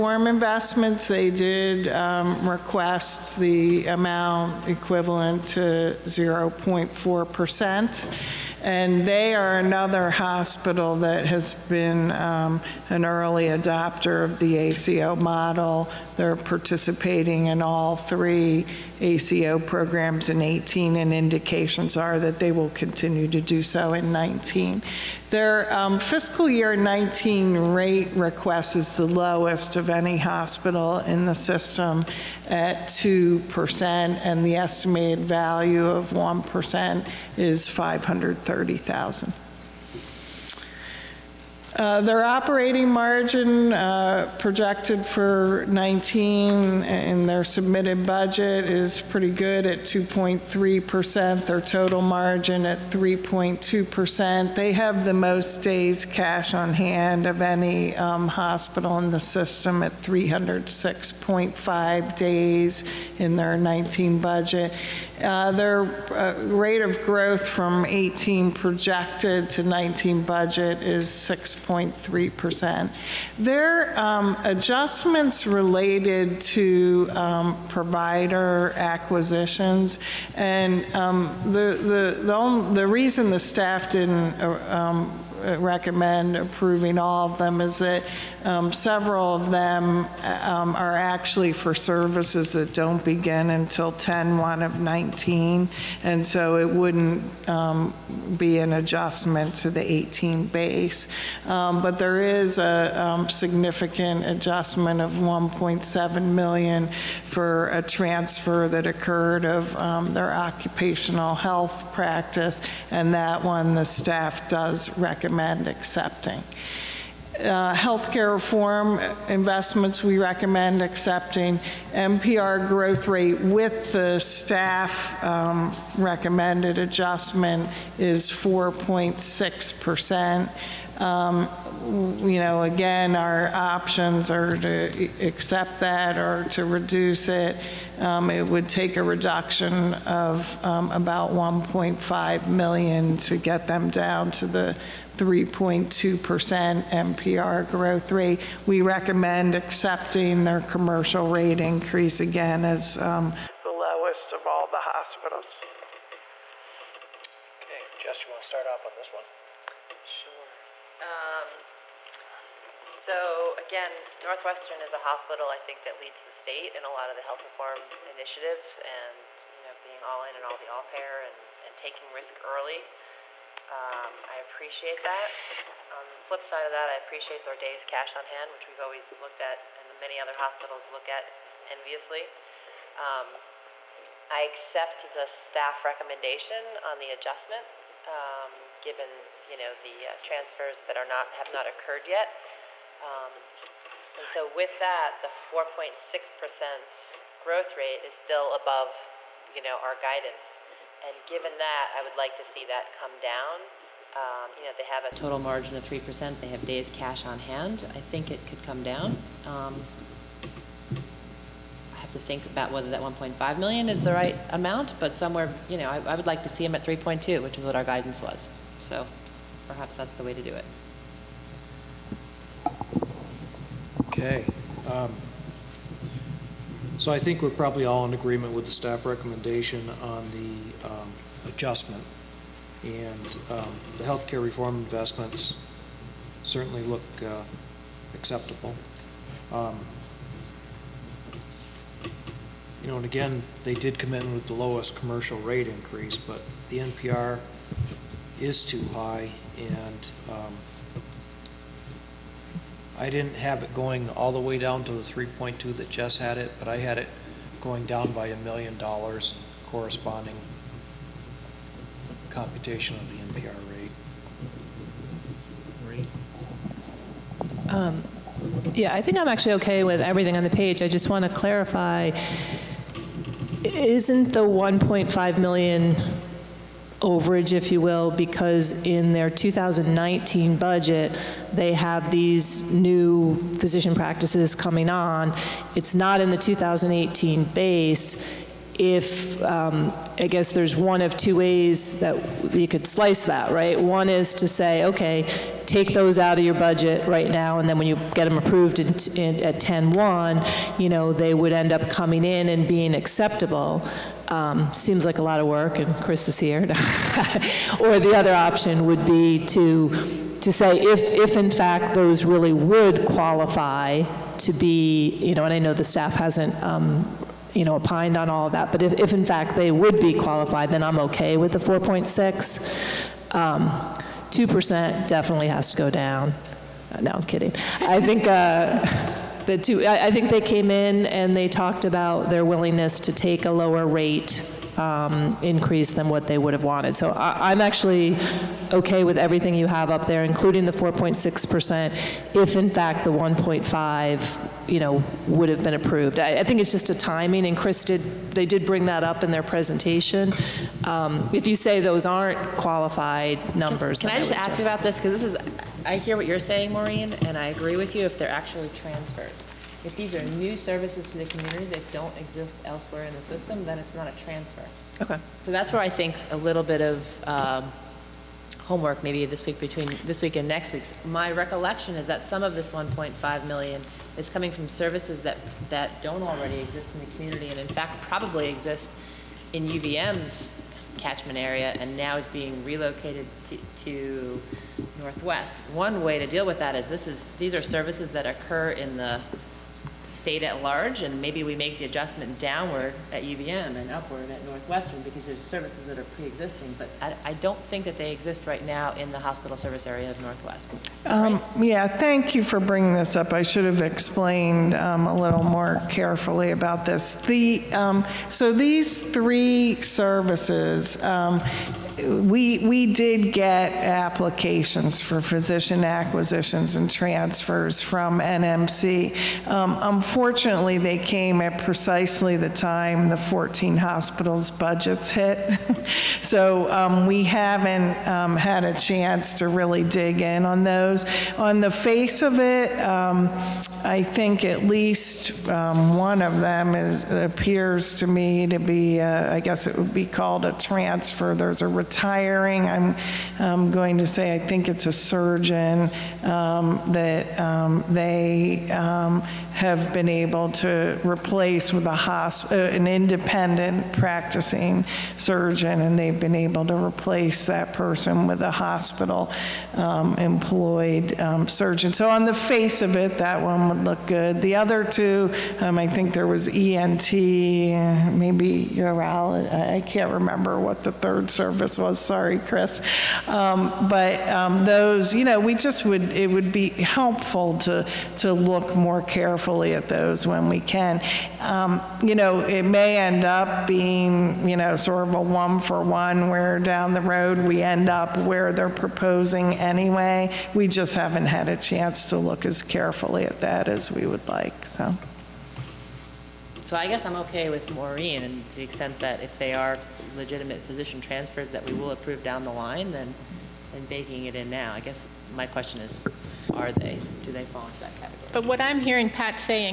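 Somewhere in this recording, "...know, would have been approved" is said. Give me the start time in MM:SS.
05:44.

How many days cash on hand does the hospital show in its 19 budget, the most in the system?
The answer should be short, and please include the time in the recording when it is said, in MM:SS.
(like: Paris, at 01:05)
306.5 days, at 01:00.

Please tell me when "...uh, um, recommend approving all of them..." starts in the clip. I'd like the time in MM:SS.
01:24.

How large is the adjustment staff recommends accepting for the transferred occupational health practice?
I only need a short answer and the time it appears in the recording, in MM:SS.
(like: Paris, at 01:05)
1.7 million, at 01:45.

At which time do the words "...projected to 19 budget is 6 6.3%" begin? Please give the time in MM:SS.
01:08.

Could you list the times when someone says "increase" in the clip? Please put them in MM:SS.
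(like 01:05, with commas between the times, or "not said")
02:31, 04:05, 05:35.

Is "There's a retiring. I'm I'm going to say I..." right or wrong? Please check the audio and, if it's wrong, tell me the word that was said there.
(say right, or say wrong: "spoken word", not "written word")
right.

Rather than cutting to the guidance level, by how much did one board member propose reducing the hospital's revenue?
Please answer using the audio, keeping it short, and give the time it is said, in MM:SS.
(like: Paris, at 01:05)
a million dollars, at 04:18.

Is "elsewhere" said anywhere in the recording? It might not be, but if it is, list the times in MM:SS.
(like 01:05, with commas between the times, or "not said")
06:02.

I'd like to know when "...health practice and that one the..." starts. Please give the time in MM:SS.
01:51.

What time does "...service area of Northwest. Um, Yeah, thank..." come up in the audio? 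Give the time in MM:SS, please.
06:39.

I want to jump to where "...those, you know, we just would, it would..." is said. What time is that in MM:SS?
07:54.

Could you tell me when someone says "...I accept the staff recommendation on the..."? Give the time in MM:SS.
03:04.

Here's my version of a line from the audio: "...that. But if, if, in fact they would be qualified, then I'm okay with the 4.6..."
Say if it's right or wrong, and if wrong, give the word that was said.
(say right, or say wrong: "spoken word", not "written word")
right.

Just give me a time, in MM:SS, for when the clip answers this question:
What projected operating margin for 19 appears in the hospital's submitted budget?
00:49.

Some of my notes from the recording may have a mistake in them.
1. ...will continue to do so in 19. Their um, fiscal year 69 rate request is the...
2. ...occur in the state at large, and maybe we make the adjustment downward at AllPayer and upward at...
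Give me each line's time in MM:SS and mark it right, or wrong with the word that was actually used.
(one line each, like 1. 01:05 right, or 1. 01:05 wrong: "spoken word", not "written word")
1. 00:22 wrong: "19", not "69"
2. 06:28 wrong: "UVM", not "AllPayer".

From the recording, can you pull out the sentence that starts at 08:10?
We just haven't had a chance to look as carefully at that as we would like, so.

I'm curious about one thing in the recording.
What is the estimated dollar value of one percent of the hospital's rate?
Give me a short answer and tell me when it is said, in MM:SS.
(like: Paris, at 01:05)
530,000, at 00:37.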